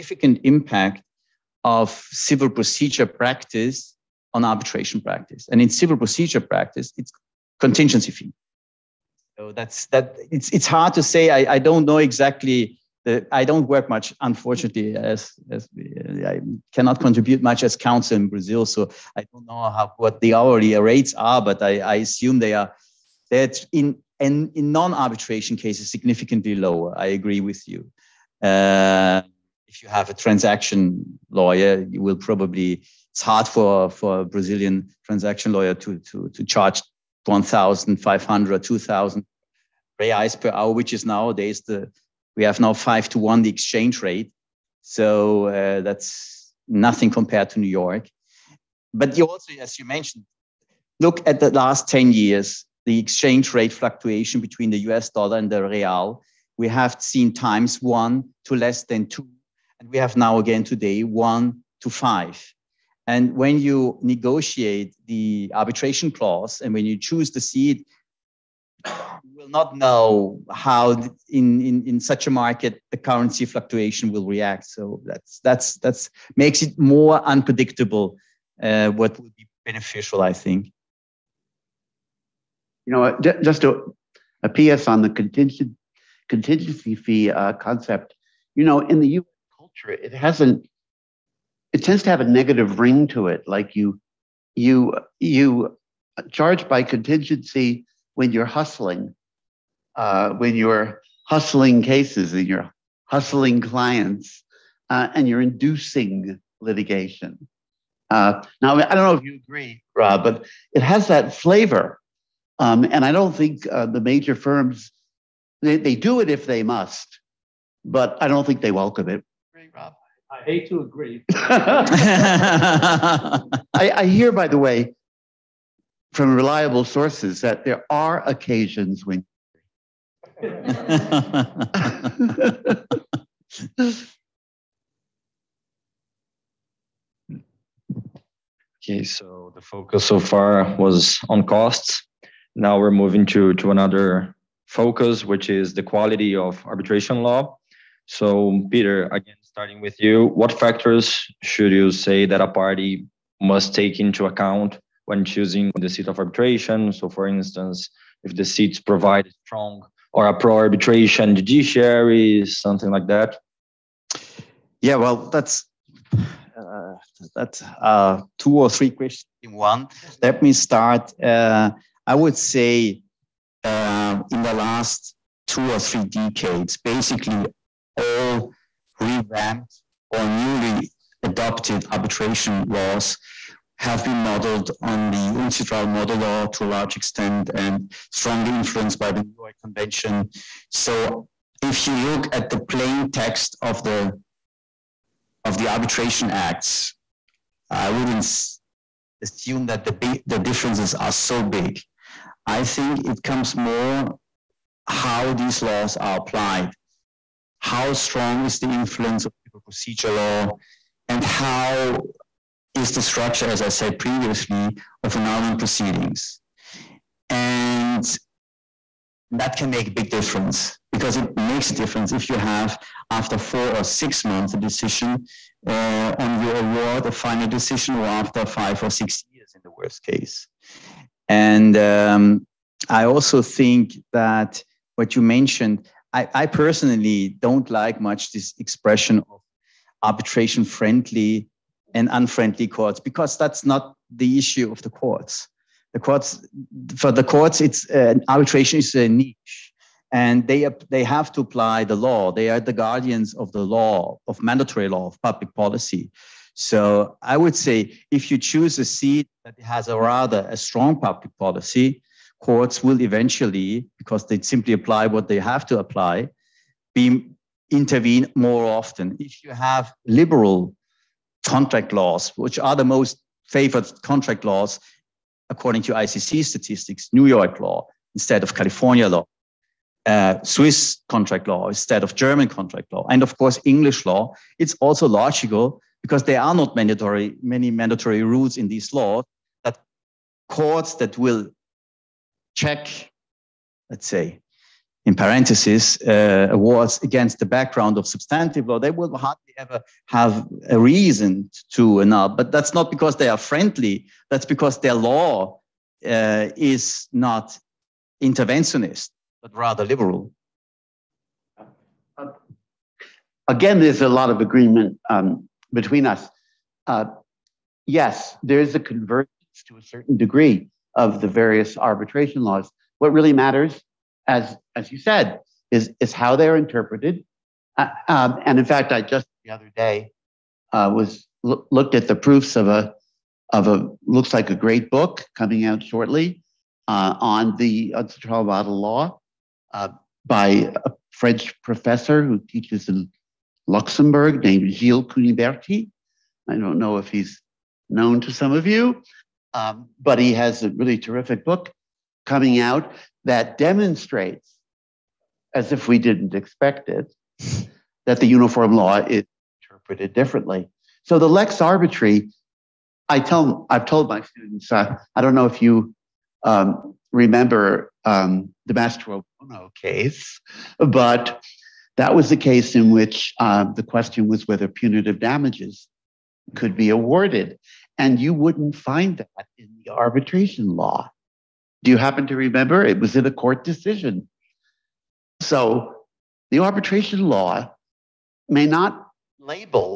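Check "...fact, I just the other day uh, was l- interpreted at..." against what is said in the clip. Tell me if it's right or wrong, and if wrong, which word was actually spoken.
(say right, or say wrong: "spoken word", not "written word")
wrong: "looked", not "interpreted".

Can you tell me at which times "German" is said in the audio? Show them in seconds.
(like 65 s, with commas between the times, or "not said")
282 s.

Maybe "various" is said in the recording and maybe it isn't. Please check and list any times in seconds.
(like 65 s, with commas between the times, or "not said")
321 s.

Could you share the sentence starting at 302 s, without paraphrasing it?
But that's not because they are friendly.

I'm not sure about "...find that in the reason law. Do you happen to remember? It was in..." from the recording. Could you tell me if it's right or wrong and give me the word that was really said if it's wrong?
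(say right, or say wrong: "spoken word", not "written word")
wrong: "arbitration", not "reason".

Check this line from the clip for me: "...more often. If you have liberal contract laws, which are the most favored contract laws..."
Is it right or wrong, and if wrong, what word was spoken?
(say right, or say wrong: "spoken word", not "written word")
right.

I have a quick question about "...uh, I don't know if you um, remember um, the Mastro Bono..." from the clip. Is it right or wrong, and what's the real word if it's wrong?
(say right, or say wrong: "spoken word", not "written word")
right.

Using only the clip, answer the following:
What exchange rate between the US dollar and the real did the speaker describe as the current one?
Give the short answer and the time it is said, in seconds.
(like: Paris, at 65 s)
5 to 1, at 42 s.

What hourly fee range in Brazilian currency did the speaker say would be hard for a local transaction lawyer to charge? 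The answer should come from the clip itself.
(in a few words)
1,500 to 2,000 reais.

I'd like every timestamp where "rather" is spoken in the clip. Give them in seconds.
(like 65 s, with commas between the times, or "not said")
259 s, 309 s.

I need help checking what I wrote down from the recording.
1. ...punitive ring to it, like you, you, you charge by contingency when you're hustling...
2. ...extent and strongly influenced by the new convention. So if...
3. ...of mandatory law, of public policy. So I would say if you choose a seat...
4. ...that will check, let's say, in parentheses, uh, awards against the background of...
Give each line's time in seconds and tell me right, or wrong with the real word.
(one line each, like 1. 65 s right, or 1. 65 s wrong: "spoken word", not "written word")
1. 92 s wrong: "negative", not "punitive"
2. 186 s right
3. 254 s right
4. 290 s right.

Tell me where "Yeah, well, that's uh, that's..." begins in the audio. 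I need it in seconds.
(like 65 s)
164 s.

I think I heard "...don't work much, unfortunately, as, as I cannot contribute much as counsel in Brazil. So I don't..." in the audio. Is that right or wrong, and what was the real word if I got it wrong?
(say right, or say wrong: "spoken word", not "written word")
right.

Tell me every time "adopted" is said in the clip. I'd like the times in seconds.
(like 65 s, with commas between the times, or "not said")
181 s.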